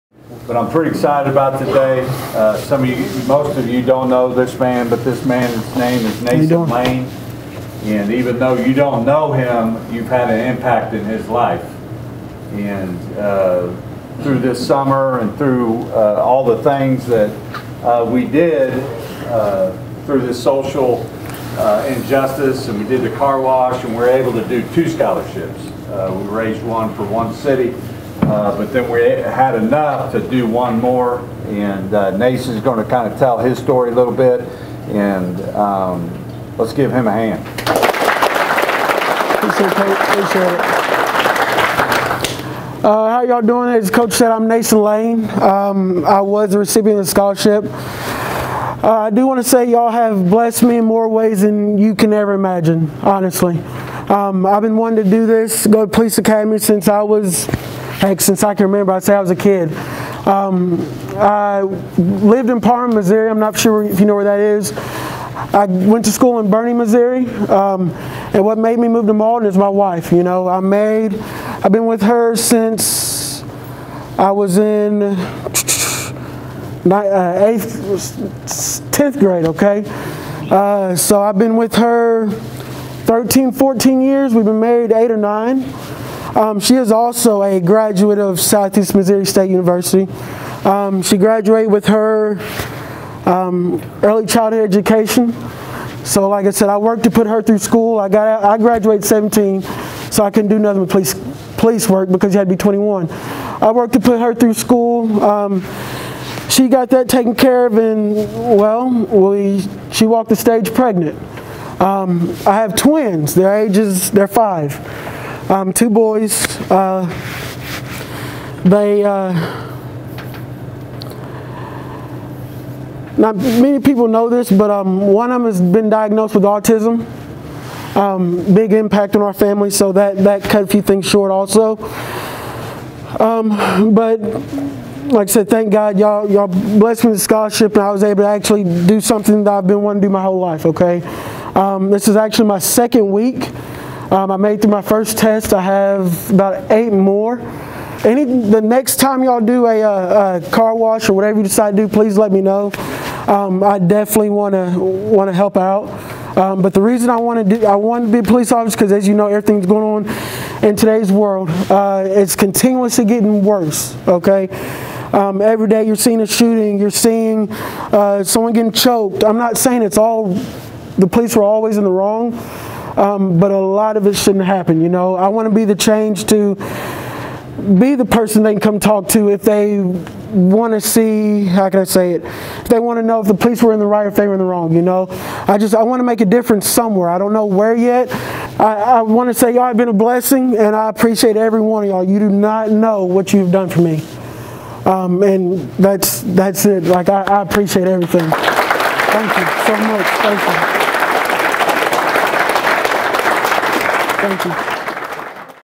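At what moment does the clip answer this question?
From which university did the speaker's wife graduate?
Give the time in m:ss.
1:28.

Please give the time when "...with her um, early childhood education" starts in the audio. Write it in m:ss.
1:31.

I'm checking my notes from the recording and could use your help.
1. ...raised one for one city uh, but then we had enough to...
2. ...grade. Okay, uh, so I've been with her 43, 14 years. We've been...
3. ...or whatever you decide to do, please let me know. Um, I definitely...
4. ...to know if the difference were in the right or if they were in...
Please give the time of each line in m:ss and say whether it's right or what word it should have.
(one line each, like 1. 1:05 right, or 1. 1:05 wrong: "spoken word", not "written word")
1. 0:26 right
2. 1:19 wrong: "13", not "43"
3. 2:31 right
4. 3:02 wrong: "police", not "difference".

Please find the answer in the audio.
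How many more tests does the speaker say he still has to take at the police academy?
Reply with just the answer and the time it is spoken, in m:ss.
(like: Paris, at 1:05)
about 8, at 2:26.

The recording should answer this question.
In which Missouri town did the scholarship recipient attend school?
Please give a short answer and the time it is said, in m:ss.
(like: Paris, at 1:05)
Bernie, Missouri, at 1:06.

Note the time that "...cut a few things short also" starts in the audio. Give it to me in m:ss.
2:10.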